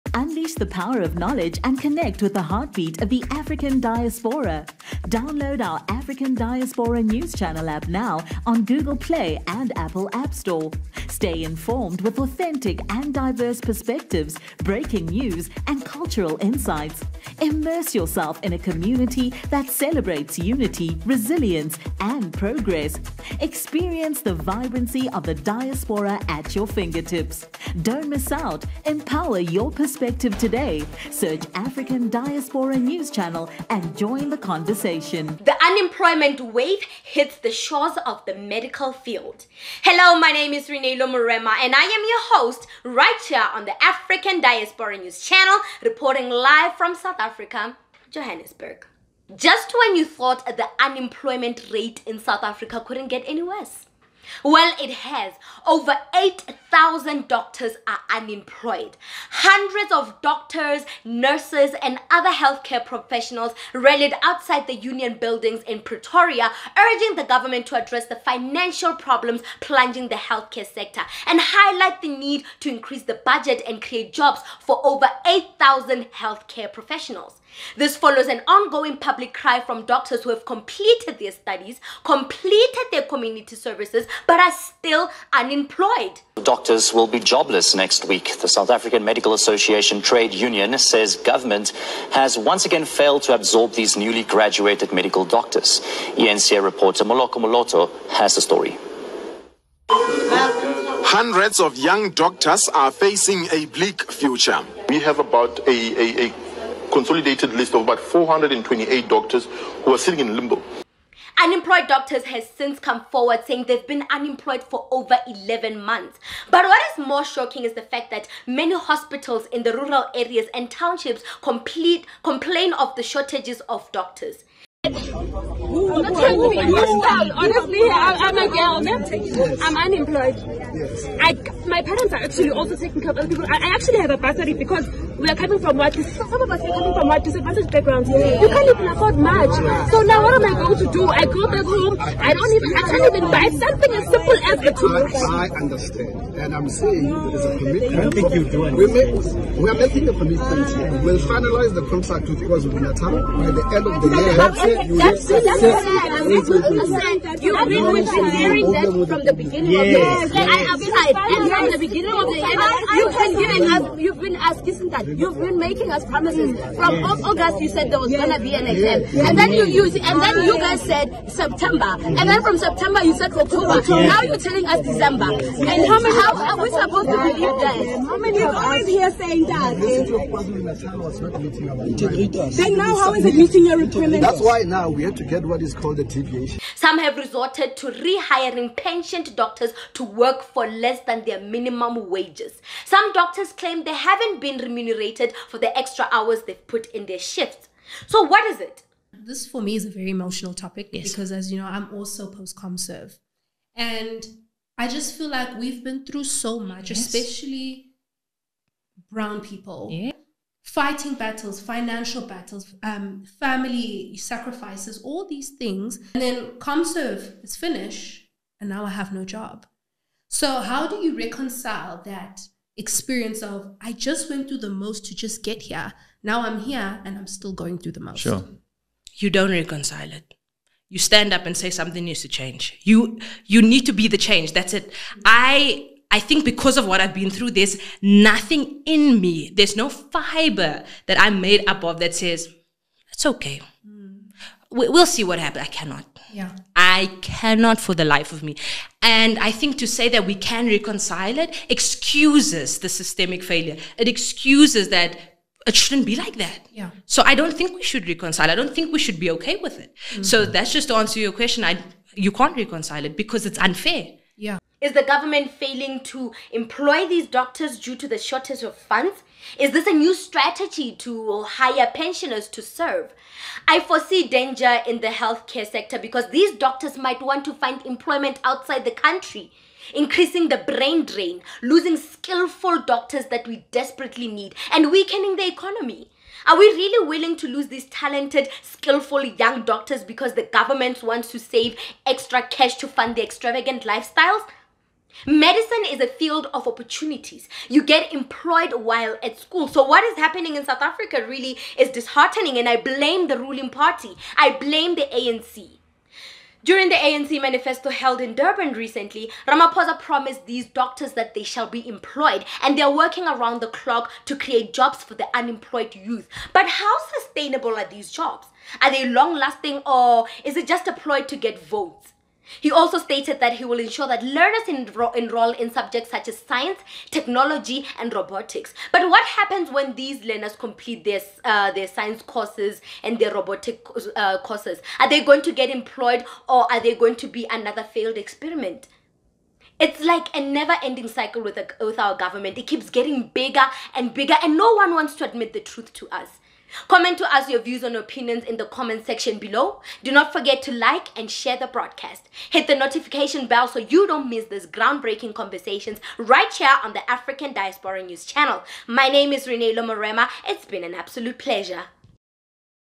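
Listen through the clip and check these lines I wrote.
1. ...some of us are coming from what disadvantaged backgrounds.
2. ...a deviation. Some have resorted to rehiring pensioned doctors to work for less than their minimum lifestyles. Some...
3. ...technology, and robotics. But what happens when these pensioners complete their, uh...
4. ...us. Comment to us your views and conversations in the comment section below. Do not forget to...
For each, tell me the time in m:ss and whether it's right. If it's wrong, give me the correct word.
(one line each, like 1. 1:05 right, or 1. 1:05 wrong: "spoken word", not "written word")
1. 2:15 right
2. 3:05 wrong: "wages", not "lifestyles"
3. 5:27 wrong: "learners", not "pensioners"
4. 5:46 wrong: "opinions", not "conversations".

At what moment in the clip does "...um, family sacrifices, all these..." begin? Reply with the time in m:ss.
3:32.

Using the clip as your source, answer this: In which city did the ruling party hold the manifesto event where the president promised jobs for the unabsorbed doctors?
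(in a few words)
Durban.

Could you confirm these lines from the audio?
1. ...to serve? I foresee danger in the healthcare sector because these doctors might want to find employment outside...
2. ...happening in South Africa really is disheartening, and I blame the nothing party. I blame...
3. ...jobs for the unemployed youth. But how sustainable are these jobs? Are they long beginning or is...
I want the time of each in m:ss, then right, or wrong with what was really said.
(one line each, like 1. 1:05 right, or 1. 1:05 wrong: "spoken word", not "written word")
1. 4:32 right
2. 5:00 wrong: "ruling", not "nothing"
3. 5:14 wrong: "lasting", not "beginning".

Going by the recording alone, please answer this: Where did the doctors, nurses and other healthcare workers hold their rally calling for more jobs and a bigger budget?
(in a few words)
Union Buildings in Pretoria.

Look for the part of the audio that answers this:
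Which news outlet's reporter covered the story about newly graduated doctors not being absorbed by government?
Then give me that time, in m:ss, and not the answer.
1:36.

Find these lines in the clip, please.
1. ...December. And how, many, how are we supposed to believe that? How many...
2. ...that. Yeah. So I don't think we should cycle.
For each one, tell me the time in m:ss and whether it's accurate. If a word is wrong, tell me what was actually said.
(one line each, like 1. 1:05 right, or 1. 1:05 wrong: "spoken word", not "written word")
1. 2:54 right
2. 4:16 wrong: "reconcile", not "cycle".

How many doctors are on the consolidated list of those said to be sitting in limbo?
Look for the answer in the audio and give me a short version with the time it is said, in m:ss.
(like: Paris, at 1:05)
428, at 1:47.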